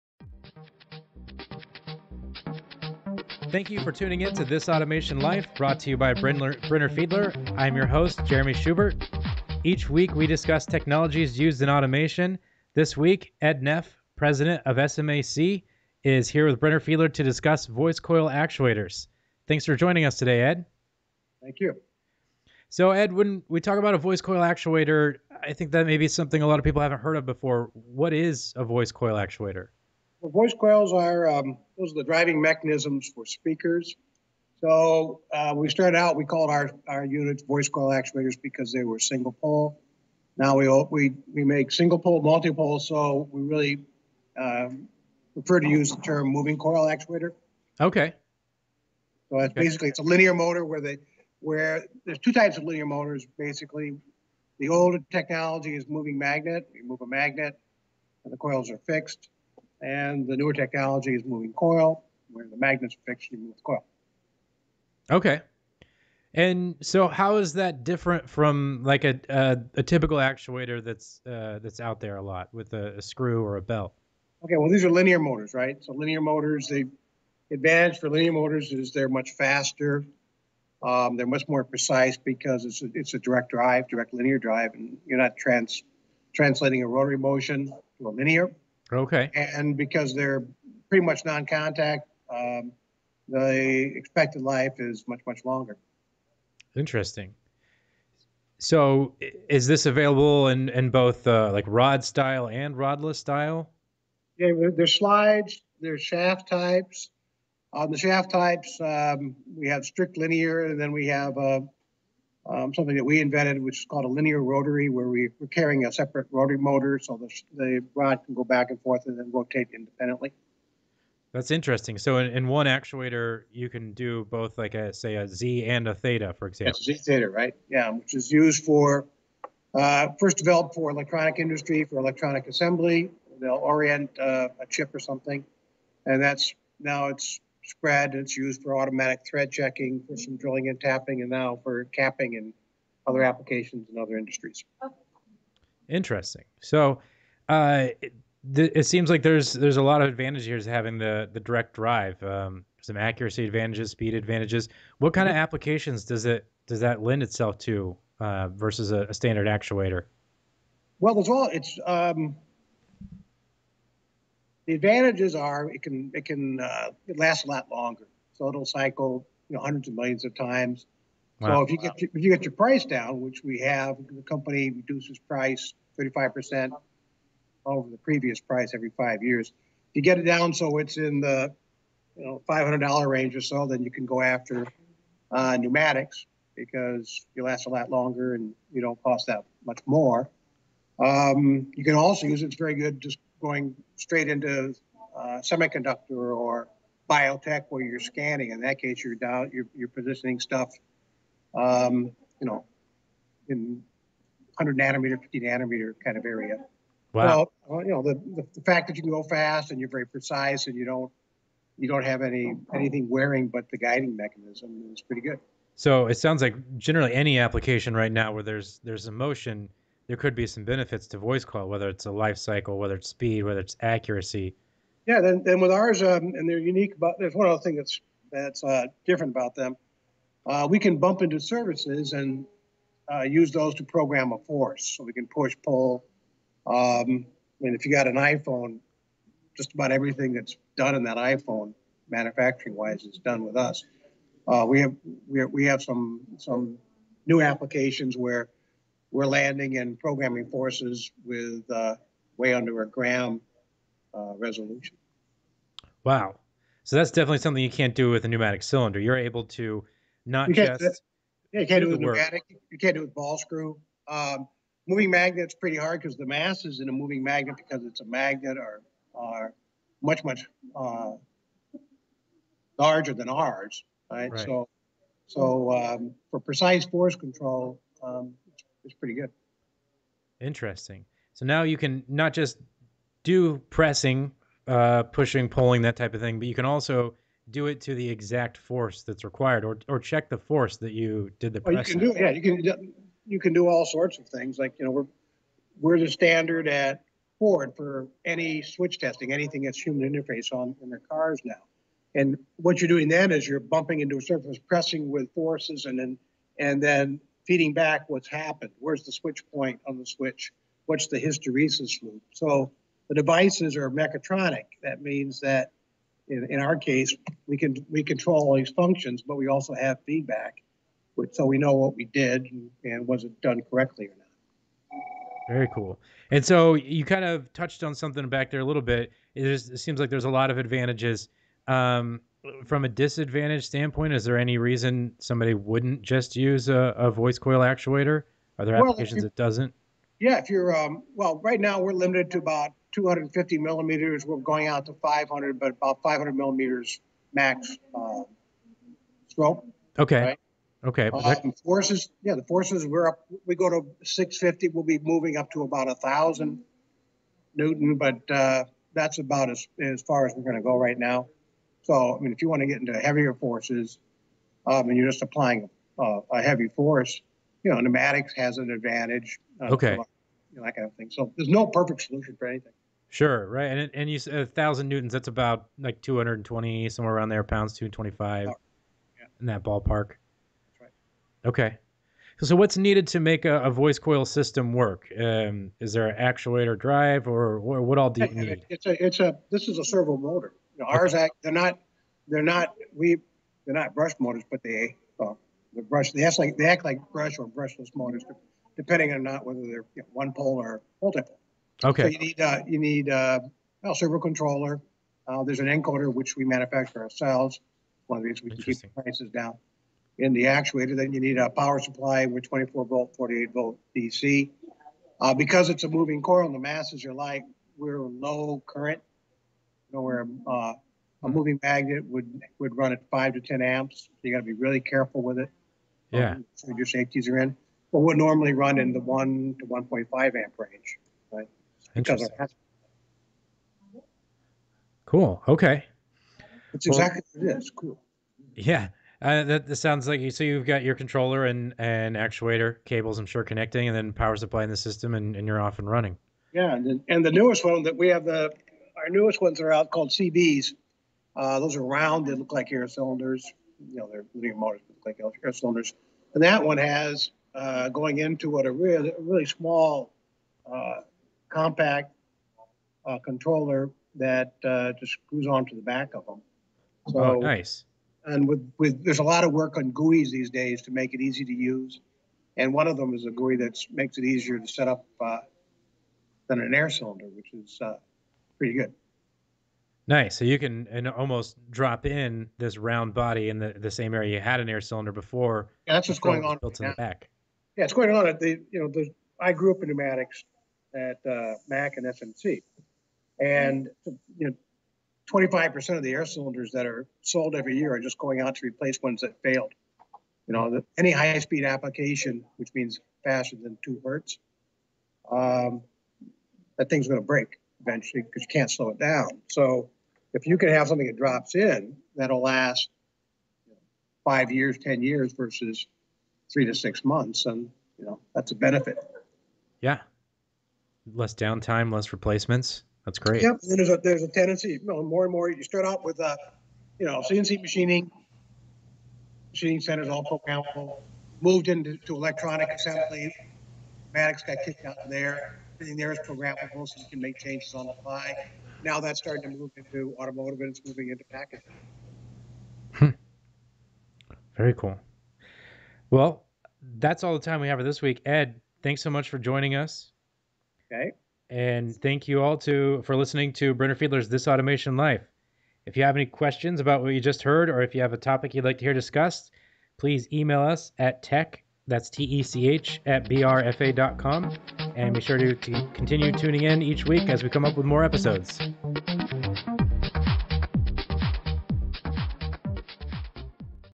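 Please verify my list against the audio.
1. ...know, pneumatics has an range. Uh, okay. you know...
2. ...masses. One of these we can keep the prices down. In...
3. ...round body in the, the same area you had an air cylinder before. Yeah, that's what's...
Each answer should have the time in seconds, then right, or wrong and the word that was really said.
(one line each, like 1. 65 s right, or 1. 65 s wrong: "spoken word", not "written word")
1. 367 s wrong: "advantage", not "range"
2. 407 s wrong: "ourselves", not "masses"
3. 482 s right.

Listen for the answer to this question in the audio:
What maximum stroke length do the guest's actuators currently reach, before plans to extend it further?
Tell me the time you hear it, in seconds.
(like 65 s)
342 s.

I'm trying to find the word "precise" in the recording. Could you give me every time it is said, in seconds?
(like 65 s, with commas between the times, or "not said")
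81 s, 210 s, 276 s.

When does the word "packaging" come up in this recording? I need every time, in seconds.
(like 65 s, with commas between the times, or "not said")
541 s.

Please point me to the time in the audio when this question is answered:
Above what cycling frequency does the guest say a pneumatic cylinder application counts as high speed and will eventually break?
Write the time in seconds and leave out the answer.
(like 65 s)
503 s.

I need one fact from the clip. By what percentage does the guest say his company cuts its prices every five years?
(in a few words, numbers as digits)
35 percent.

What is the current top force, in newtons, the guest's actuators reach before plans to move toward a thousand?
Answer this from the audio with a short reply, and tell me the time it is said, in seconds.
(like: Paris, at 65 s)
650, at 354 s.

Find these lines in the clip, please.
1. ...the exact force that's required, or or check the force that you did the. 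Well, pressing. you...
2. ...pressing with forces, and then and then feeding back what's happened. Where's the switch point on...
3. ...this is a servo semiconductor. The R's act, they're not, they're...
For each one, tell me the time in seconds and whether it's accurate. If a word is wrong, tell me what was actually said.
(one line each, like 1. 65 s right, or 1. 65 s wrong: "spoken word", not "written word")
1. 287 s right
2. 304 s right
3. 389 s wrong: "motor", not "semiconductor".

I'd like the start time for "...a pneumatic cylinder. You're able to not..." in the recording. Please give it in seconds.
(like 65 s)
258 s.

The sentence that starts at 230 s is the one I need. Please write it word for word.
Uh, we can bump into services and uh, use those to program a force.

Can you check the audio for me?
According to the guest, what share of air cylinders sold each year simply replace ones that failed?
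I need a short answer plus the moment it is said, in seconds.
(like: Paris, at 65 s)
25%, at 495 s.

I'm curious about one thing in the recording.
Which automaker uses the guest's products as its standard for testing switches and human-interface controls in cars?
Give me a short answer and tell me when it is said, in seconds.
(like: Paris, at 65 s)
Ford, at 297 s.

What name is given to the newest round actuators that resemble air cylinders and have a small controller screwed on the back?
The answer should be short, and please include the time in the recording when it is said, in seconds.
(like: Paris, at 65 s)
CBs, at 450 s.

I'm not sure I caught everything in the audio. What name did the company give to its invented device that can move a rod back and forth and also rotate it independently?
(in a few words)
linear rotary.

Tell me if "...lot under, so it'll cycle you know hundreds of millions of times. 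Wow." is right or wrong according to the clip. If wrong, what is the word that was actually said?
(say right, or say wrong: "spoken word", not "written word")
wrong: "longer", not "under".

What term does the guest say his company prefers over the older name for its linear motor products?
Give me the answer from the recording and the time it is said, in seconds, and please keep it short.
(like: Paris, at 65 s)
moving coil actuator, at 46 s.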